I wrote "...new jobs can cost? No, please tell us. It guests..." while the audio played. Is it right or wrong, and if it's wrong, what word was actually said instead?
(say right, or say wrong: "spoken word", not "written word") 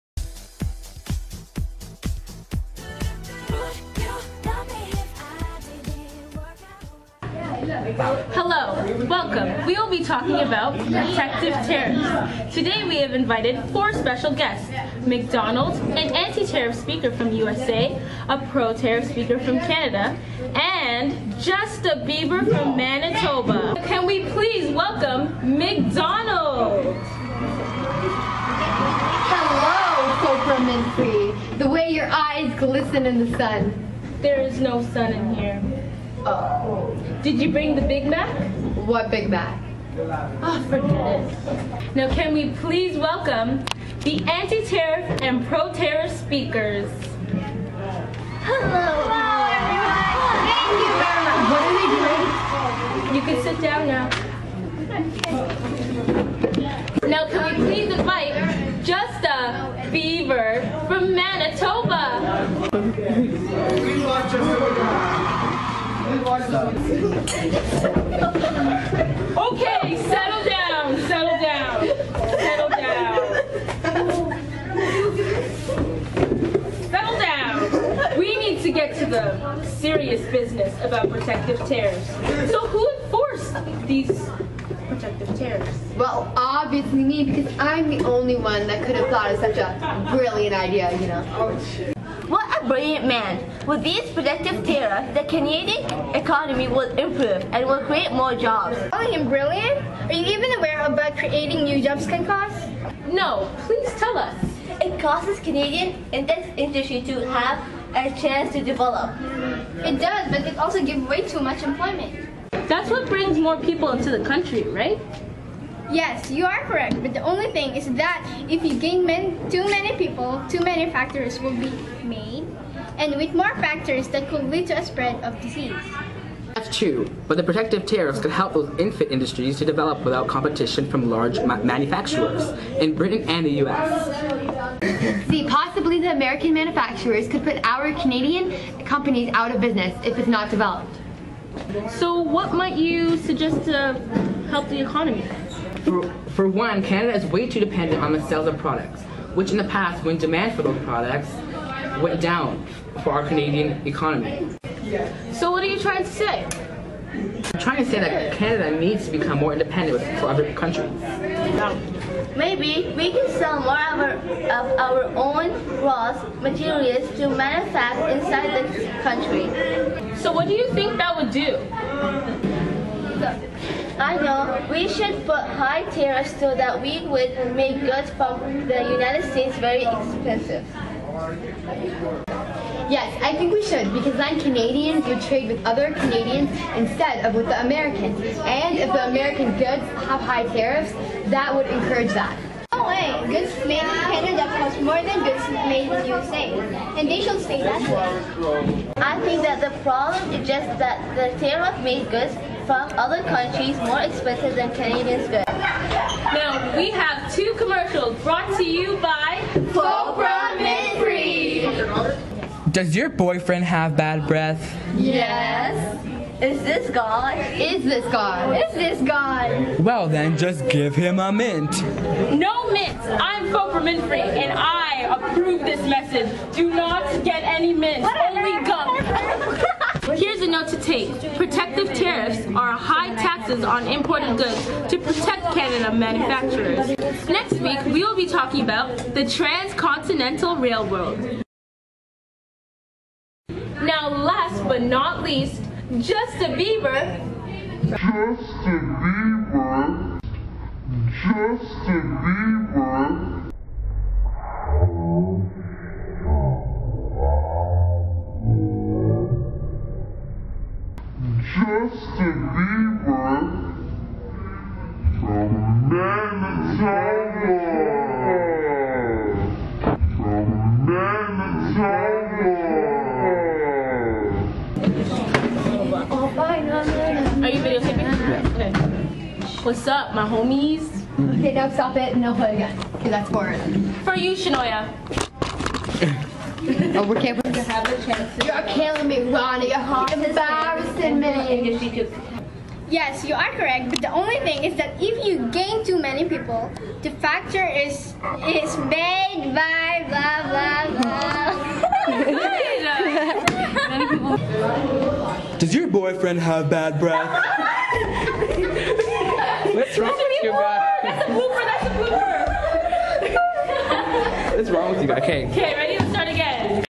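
wrong: "costs", not "guests".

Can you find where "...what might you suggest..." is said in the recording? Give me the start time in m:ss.
2:22.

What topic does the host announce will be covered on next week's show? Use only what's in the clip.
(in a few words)
The Transcontinental Railroad.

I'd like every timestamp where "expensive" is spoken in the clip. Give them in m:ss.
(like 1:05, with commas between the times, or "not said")
2:59, 3:24.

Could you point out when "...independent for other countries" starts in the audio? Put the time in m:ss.
2:39.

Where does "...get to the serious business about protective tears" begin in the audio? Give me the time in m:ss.
1:18.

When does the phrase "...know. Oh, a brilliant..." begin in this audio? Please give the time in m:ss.
1:31.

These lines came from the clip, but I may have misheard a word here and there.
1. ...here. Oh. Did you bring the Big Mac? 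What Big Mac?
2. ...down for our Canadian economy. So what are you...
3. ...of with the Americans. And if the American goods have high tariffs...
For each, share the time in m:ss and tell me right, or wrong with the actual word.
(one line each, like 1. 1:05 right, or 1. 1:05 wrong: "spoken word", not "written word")
1. 0:35 right
2. 2:32 right
3. 3:07 right.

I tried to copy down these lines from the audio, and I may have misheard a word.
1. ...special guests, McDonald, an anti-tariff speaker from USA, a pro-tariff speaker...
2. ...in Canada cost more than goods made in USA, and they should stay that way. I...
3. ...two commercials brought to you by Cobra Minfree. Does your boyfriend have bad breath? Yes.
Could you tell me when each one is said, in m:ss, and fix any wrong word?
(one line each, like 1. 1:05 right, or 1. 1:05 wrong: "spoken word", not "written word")
1. 0:13 right
2. 3:13 right
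3. 3:27 right.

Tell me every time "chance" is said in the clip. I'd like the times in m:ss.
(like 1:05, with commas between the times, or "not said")
1:48, 4:48.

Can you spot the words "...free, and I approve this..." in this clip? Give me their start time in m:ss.
3:44.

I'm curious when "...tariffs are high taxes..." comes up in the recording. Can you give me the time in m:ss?
3:51.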